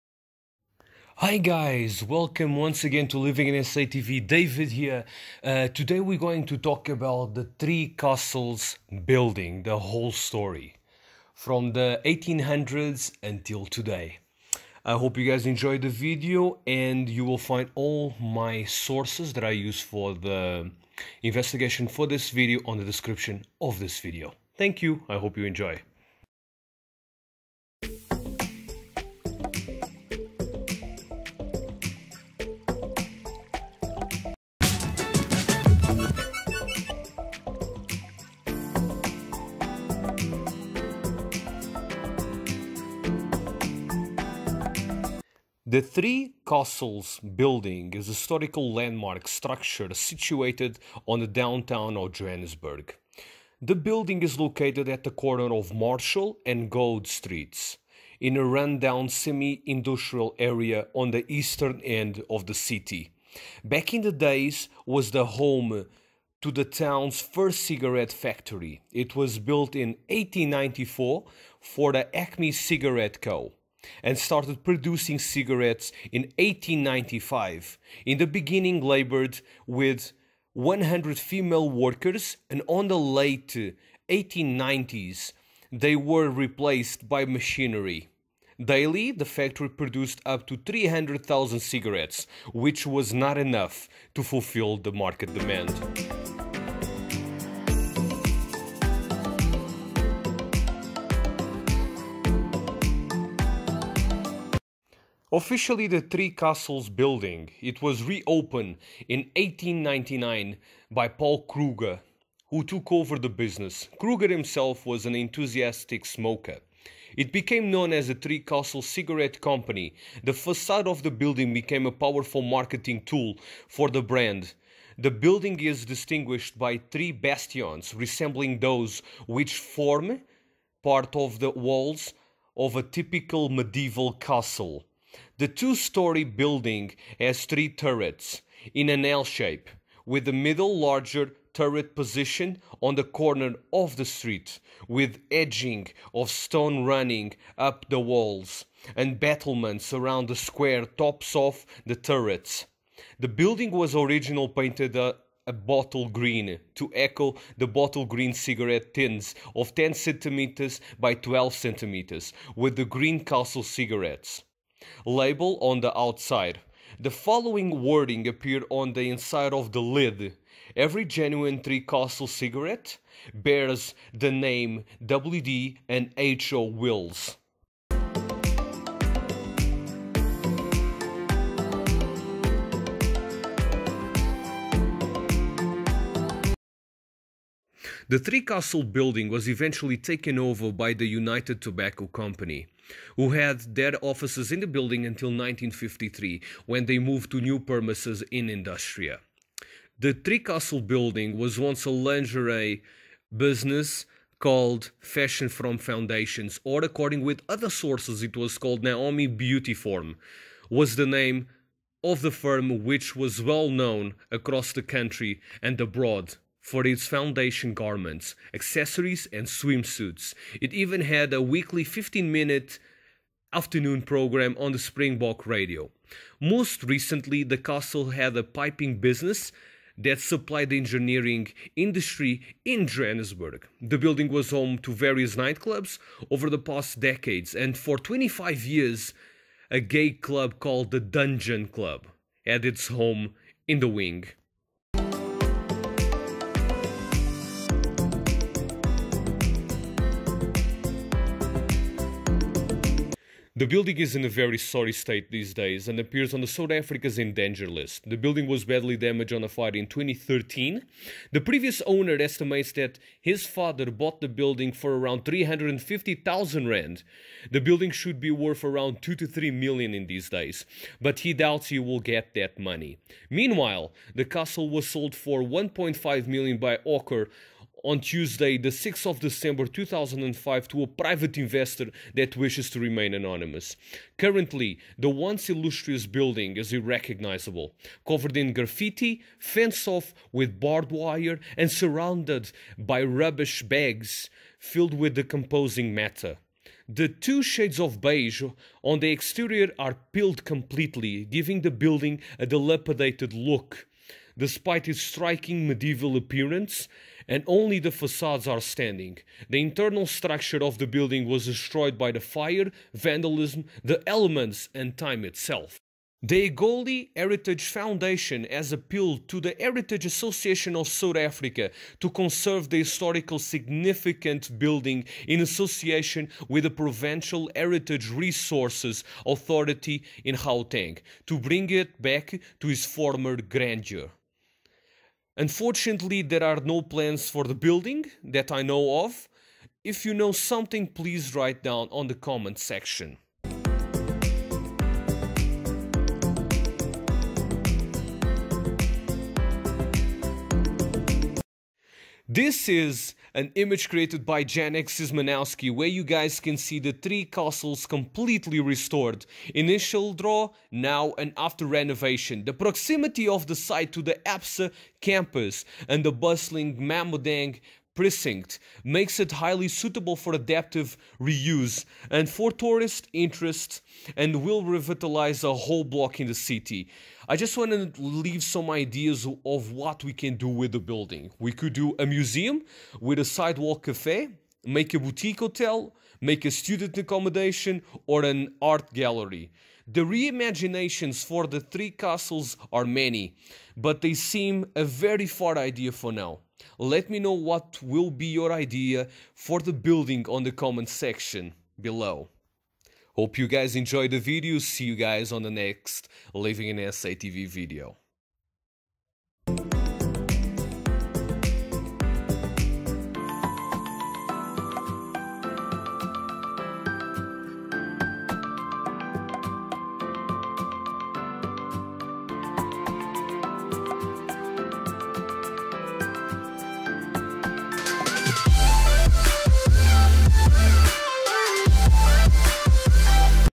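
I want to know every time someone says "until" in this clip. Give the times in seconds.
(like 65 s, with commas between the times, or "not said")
13 s, 195 s.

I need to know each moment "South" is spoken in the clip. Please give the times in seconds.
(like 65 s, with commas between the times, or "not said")
256 s, 320 s.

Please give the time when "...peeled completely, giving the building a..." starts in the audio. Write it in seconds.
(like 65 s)
300 s.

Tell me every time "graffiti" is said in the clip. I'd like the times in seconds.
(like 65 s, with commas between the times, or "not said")
288 s.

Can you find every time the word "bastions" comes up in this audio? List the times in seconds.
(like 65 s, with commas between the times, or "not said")
127 s.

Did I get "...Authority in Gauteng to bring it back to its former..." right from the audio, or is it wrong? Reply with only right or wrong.
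right.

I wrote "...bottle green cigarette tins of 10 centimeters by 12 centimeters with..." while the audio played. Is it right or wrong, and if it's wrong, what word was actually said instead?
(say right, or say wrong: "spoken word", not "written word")
right.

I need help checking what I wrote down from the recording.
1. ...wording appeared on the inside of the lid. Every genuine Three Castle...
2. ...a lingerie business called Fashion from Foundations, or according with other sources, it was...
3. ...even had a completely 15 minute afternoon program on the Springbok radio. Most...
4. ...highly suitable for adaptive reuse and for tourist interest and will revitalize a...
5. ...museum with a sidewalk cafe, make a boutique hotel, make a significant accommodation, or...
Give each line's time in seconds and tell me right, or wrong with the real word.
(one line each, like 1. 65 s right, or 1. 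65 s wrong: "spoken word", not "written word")
1. 167 s right
2. 201 s right
3. 220 s wrong: "weekly", not "completely"
4. 369 s right
5. 382 s wrong: "student", not "significant".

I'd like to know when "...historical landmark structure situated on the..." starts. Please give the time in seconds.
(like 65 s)
48 s.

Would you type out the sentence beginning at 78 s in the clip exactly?
In the beginning, labored with 100 female workers, and on the late 1890s, they were replaced by machinery.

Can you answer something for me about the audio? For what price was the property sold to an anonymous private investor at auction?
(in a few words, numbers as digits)
1.5 million rand.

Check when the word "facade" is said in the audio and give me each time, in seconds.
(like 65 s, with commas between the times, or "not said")
120 s, 307 s.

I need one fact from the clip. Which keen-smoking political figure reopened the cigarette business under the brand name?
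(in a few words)
Paul Kruger.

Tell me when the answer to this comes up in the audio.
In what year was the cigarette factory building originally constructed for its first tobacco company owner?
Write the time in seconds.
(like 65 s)
70 s.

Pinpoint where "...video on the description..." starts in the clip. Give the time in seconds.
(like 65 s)
22 s.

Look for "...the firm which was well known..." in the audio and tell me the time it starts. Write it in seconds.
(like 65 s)
212 s.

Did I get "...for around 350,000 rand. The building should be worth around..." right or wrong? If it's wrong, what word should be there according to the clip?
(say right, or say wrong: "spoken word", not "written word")
right.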